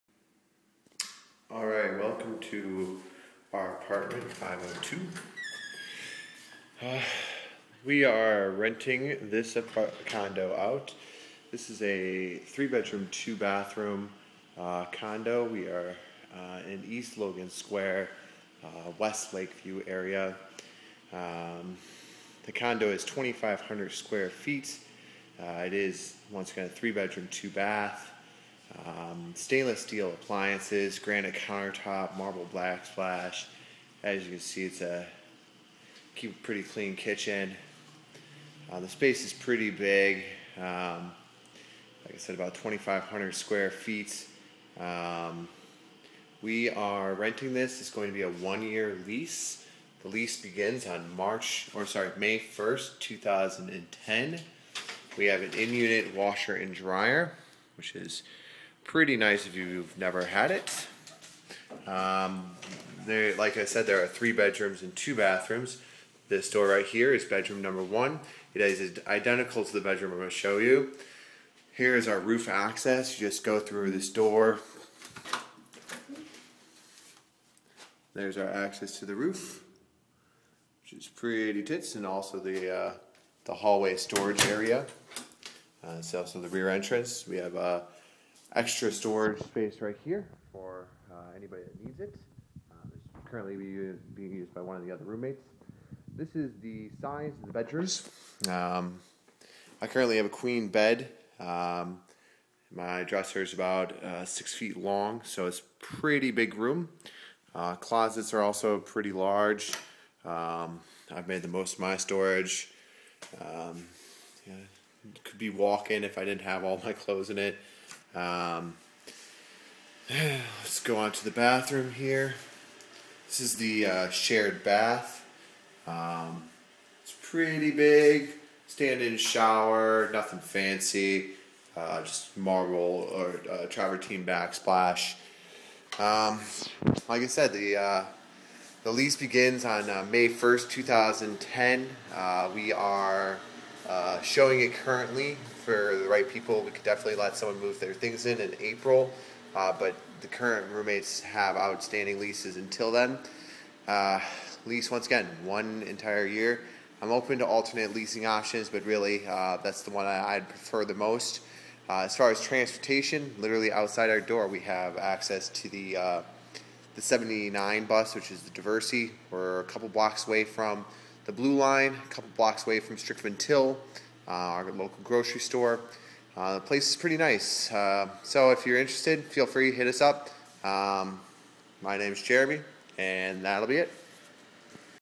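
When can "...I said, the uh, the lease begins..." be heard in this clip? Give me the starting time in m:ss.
2:17.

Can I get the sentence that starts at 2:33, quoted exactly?
Uh, lease once again, one entire year.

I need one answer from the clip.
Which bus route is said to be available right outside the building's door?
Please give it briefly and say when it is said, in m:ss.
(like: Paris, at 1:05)
79, at 2:47.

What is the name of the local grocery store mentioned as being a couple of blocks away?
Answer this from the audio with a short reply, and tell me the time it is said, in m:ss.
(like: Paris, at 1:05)
Strickland Till, at 2:52.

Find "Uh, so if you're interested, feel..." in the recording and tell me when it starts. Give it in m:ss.
2:57.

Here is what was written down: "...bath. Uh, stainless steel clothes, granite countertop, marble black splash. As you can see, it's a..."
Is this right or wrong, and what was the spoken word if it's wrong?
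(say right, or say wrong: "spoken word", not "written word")
wrong: "appliances", not "clothes".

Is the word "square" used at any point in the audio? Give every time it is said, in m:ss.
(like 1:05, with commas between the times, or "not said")
0:17, 0:23, 0:43.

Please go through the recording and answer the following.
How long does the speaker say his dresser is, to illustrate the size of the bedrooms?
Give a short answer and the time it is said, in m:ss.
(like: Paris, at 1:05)
6 feet, at 1:44.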